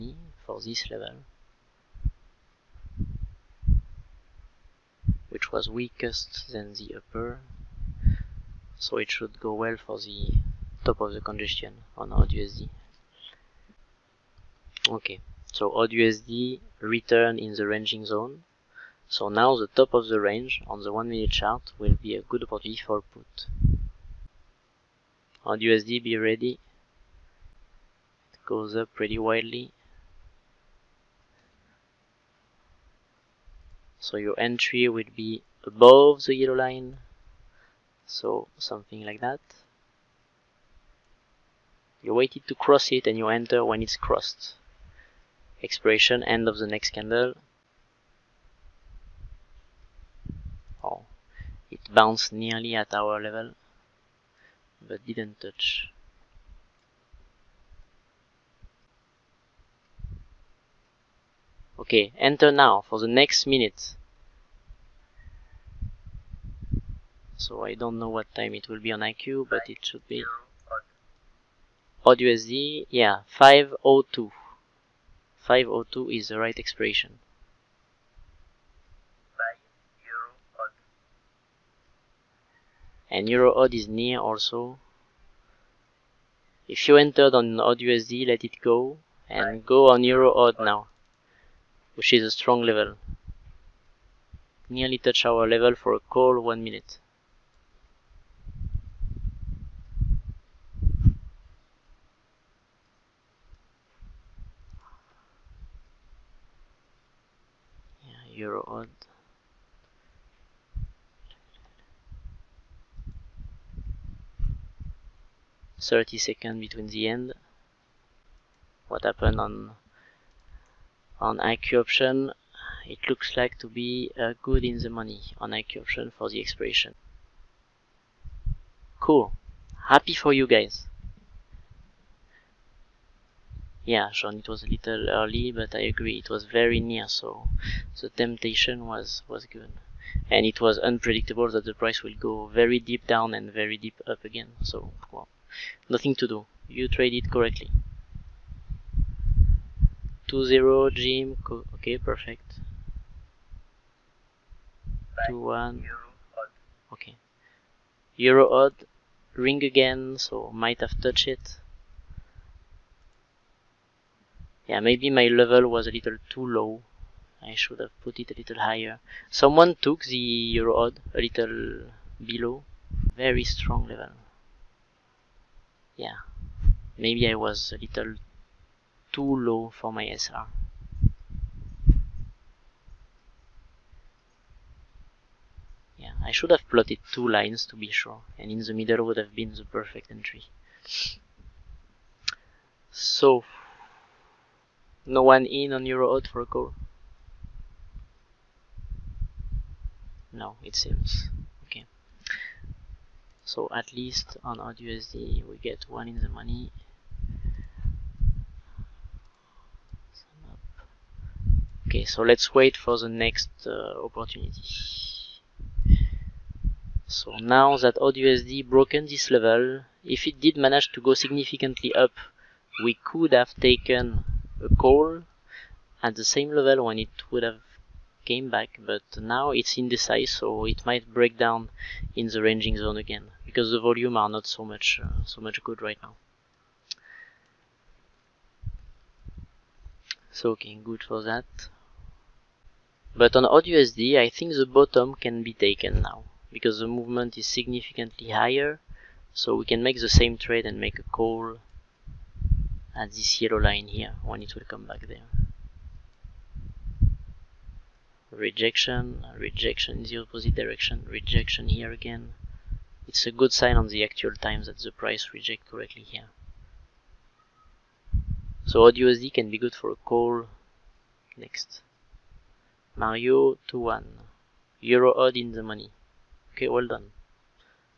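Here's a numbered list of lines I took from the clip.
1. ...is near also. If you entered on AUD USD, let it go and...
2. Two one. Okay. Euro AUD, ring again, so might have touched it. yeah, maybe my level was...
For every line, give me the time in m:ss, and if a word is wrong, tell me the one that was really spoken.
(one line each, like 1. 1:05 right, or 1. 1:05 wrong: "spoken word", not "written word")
1. 1:23 right
2. 2:35 right.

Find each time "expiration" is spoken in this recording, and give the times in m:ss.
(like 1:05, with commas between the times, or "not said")
0:45, 1:16, 2:06.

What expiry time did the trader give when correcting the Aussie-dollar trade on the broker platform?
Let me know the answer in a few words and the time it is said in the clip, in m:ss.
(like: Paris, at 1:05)
502, at 1:13.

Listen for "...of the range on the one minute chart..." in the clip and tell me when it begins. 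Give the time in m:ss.
0:19.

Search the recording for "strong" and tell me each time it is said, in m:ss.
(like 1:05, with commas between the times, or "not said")
1:32, 2:53.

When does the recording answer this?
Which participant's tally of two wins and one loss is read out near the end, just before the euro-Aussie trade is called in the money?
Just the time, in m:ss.
4:32.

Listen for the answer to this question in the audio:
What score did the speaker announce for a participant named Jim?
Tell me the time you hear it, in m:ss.
2:30.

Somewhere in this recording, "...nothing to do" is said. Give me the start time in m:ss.
2:25.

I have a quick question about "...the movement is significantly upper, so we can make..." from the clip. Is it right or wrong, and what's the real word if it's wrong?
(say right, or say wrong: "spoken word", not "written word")
wrong: "higher", not "upper".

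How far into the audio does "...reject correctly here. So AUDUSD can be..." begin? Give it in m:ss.
4:25.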